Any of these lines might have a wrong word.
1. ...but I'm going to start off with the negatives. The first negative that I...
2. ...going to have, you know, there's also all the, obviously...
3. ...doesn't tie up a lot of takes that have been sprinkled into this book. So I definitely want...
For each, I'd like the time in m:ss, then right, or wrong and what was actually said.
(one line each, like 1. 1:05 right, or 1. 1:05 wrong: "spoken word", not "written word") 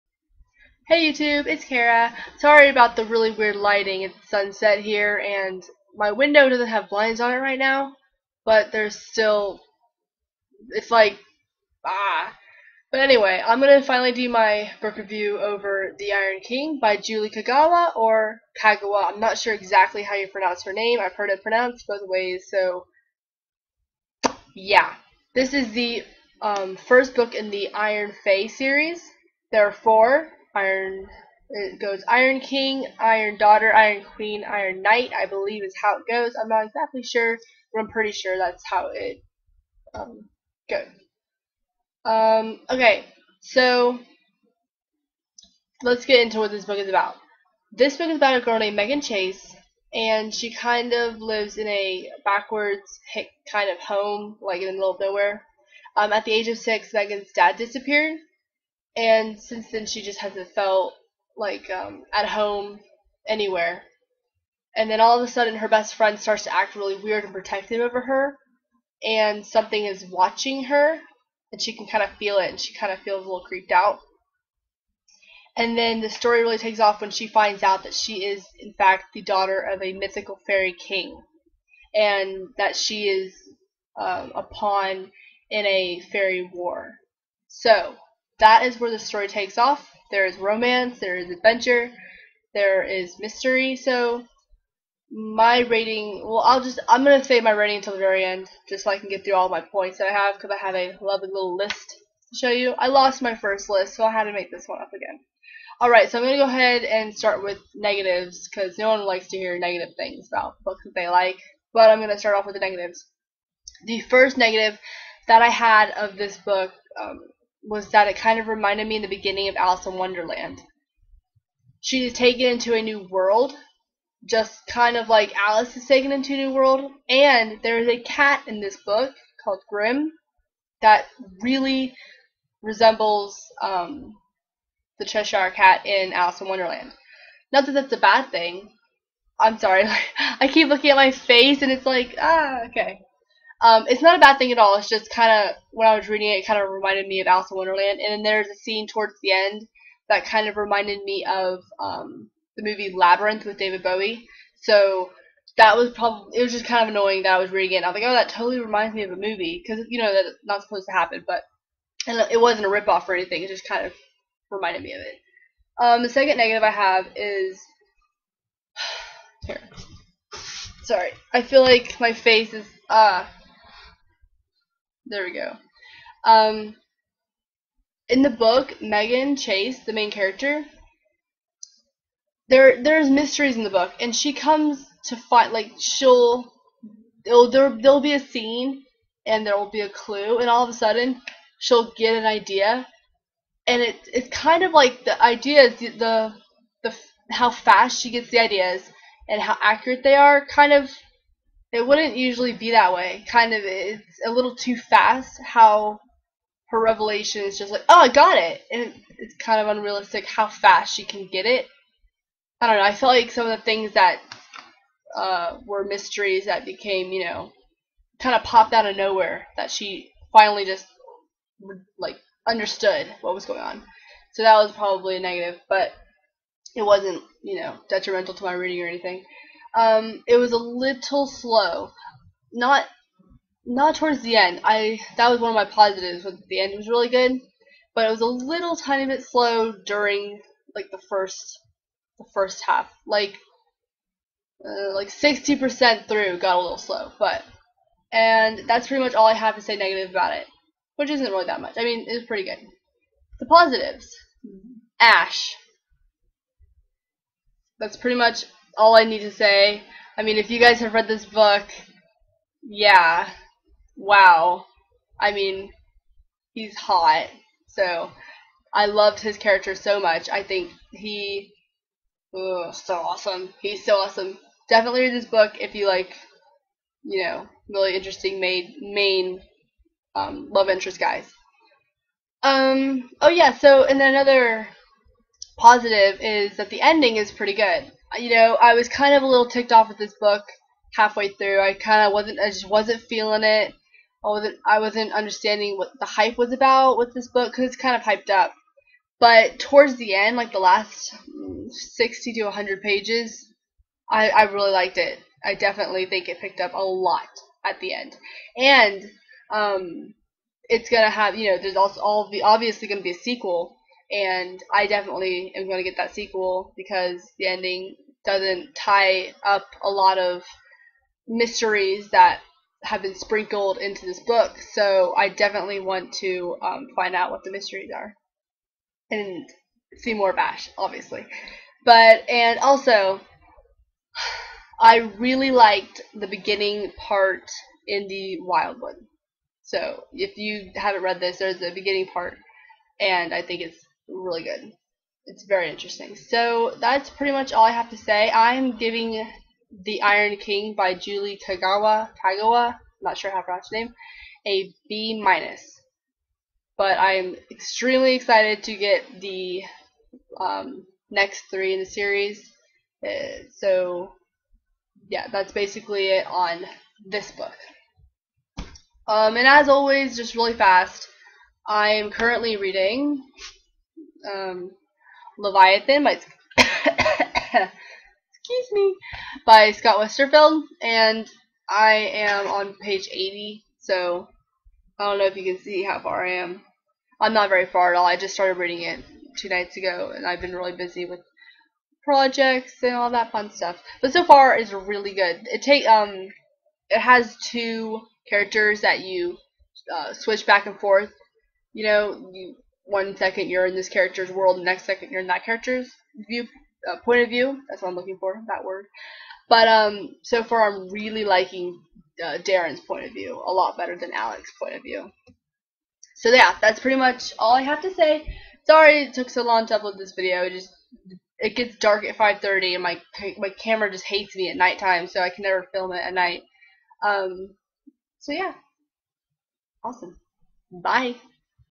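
1. 1:51 right
2. 5:10 right
3. 5:18 wrong: "mysteries", not "takes".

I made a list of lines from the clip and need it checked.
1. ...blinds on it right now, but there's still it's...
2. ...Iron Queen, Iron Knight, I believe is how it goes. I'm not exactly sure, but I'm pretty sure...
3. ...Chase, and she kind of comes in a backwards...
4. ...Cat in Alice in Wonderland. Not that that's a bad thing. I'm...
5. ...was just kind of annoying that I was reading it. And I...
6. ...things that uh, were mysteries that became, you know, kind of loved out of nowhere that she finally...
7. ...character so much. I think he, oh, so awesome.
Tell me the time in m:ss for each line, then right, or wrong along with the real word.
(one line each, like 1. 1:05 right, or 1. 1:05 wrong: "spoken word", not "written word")
1. 0:06 right
2. 0:33 right
3. 0:49 wrong: "lives", not "comes"
4. 2:15 right
5. 2:36 right
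6. 3:33 wrong: "popped", not "loved"
7. 4:29 right.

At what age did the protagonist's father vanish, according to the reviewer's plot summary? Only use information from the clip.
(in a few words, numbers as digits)
6.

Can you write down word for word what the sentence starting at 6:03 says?
Uh, so yeah, that's basically it on this book.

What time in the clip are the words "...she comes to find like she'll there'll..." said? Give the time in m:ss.
3:04.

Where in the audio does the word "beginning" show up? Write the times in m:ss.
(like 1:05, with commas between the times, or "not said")
1:59, 5:36, 5:41.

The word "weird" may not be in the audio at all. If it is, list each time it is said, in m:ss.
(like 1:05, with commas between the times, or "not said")
0:03, 1:07.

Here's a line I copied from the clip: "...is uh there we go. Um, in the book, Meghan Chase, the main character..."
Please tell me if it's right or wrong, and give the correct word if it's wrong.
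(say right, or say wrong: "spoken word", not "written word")
right.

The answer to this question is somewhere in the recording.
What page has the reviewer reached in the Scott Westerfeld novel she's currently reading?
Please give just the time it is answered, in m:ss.
6:23.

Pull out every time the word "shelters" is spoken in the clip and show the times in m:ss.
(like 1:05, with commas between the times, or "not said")
not said.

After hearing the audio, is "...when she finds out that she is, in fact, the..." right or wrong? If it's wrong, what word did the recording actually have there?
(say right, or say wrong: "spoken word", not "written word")
right.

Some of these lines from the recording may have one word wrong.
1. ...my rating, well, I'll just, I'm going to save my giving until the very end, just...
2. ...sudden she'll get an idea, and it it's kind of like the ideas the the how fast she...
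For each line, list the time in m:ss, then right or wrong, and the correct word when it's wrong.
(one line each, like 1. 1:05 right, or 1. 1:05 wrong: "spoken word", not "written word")
1. 1:35 wrong: "rating", not "giving"
2. 3:10 right.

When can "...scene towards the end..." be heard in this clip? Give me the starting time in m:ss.
2:28.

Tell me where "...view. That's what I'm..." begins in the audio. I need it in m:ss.
6:47.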